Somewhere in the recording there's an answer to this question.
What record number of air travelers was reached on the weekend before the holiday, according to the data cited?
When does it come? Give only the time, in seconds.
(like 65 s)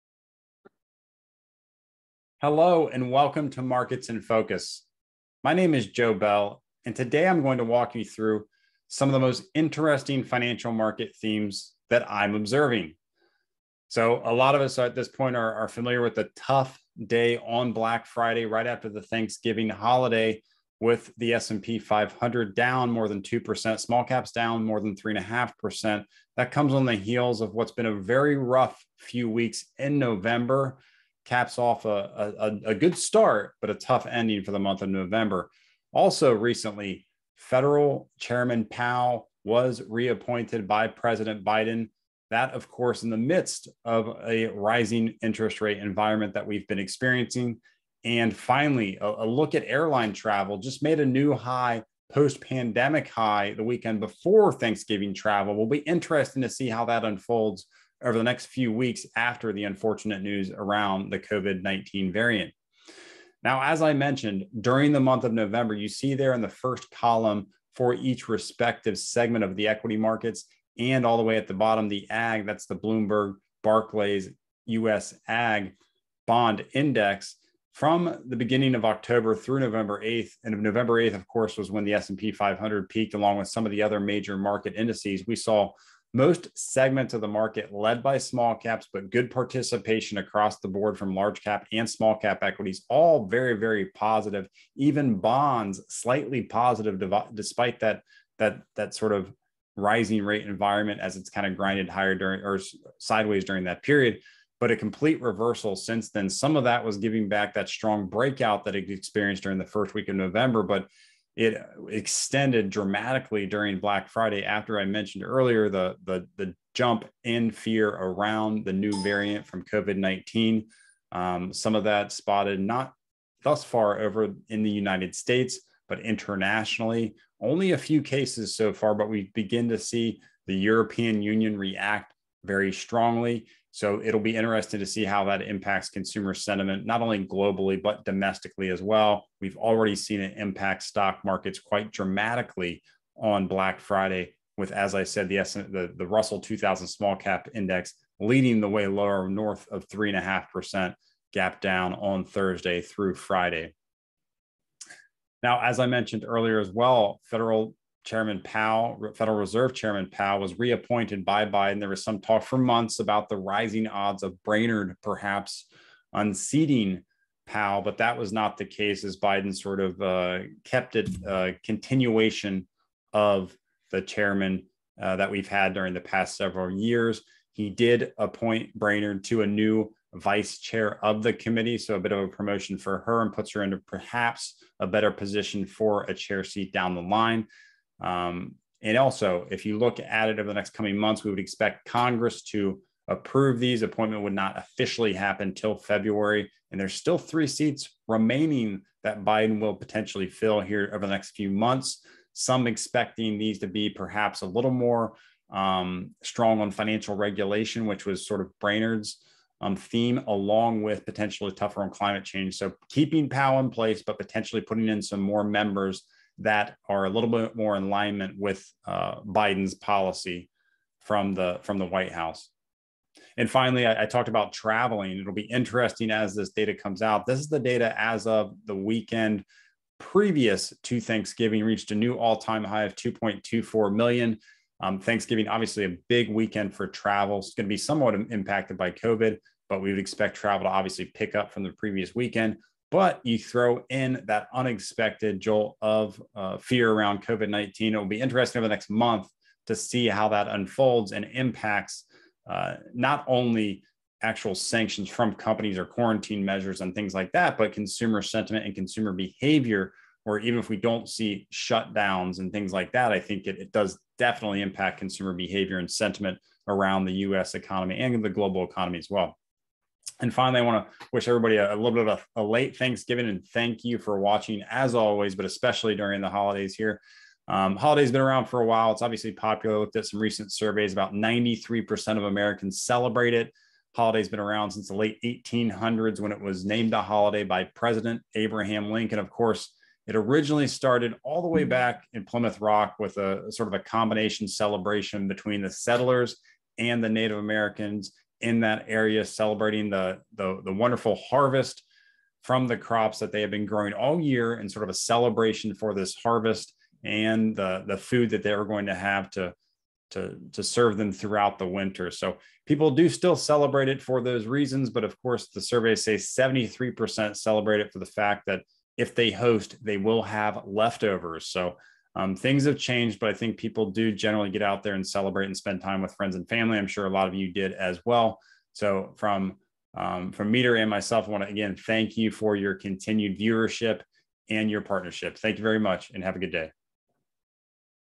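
232 s.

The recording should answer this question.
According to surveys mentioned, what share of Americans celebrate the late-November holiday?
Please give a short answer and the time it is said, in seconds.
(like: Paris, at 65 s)
93%, at 281 s.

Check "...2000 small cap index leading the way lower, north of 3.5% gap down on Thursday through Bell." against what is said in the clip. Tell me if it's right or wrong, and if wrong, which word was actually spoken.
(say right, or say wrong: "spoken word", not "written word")
wrong: "Friday", not "Bell".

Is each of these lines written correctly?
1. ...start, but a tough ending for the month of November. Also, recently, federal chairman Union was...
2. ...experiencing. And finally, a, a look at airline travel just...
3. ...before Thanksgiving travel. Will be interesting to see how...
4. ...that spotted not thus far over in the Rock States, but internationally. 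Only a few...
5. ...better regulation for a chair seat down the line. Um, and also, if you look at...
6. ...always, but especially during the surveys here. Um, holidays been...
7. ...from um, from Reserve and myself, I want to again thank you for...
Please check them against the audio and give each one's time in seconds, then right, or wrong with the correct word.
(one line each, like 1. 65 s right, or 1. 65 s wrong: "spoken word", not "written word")
1. 32 s wrong: "Powell", not "Union"
2. 46 s right
3. 53 s right
4. 121 s wrong: "United", not "Rock"
5. 184 s wrong: "position", not "regulation"
6. 274 s wrong: "holidays", not "surveys"
7. 329 s wrong: "Meeder", not "Reserve".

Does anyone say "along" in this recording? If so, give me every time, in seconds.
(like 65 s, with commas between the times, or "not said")
83 s, 210 s.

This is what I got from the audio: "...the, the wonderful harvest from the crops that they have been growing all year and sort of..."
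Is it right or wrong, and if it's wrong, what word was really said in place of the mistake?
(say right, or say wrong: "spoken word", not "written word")
right.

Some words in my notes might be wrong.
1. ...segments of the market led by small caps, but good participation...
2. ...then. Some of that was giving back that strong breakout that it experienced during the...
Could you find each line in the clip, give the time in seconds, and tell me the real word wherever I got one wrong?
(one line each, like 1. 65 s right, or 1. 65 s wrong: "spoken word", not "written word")
1. 86 s right
2. 106 s right.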